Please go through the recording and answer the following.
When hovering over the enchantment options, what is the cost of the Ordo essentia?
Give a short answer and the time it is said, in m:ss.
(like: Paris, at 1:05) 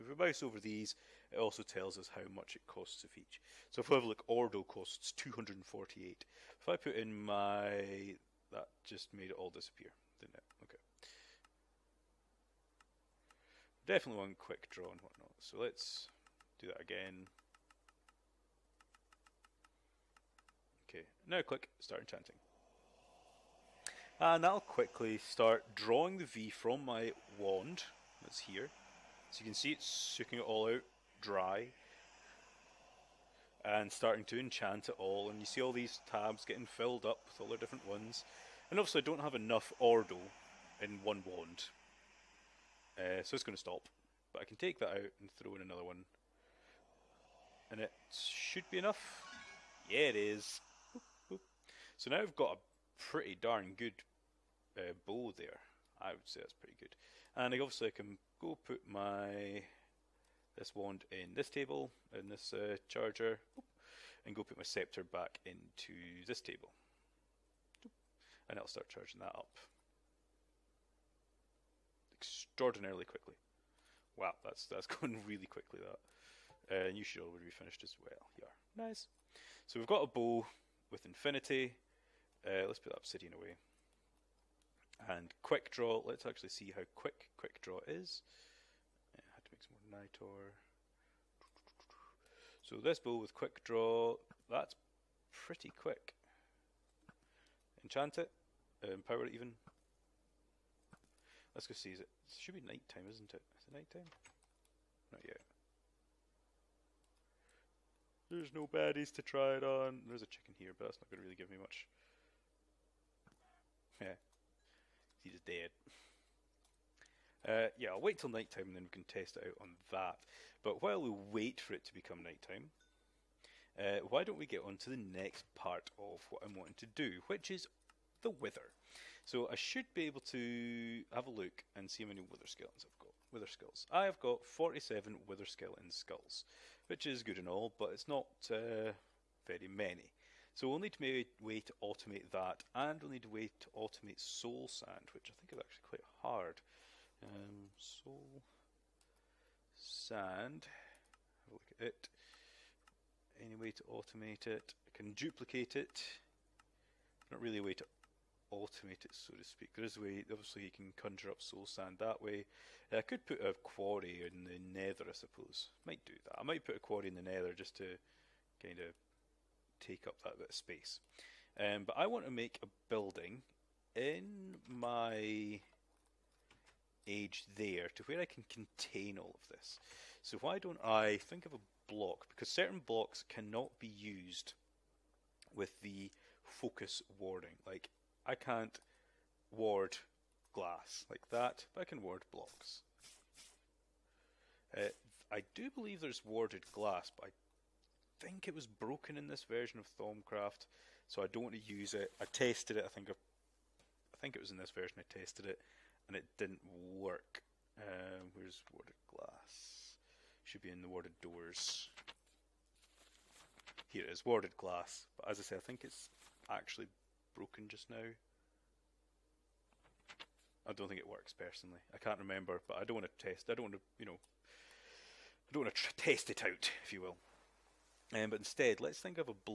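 248, at 0:05.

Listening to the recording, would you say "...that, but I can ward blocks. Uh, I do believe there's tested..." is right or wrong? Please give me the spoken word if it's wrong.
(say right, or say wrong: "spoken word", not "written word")
wrong: "warded", not "tested".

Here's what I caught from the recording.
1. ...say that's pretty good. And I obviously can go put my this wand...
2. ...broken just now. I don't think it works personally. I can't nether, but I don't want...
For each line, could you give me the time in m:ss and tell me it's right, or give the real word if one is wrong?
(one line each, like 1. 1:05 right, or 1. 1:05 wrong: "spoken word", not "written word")
1. 0:56 right
2. 3:37 wrong: "remember", not "nether".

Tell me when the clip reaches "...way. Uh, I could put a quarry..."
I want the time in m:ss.
2:42.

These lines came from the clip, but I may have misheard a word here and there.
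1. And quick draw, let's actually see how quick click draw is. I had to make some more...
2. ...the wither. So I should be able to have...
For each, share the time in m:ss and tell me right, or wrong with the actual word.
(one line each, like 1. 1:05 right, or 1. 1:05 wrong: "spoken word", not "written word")
1. 1:25 wrong: "quick", not "click"
2. 2:08 right.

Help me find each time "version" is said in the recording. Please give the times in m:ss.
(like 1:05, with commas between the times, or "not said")
3:19, 3:24.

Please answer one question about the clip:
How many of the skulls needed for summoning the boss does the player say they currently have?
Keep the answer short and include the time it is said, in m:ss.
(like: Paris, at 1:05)
47, at 2:14.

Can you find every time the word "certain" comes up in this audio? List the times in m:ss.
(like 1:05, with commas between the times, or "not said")
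3:02.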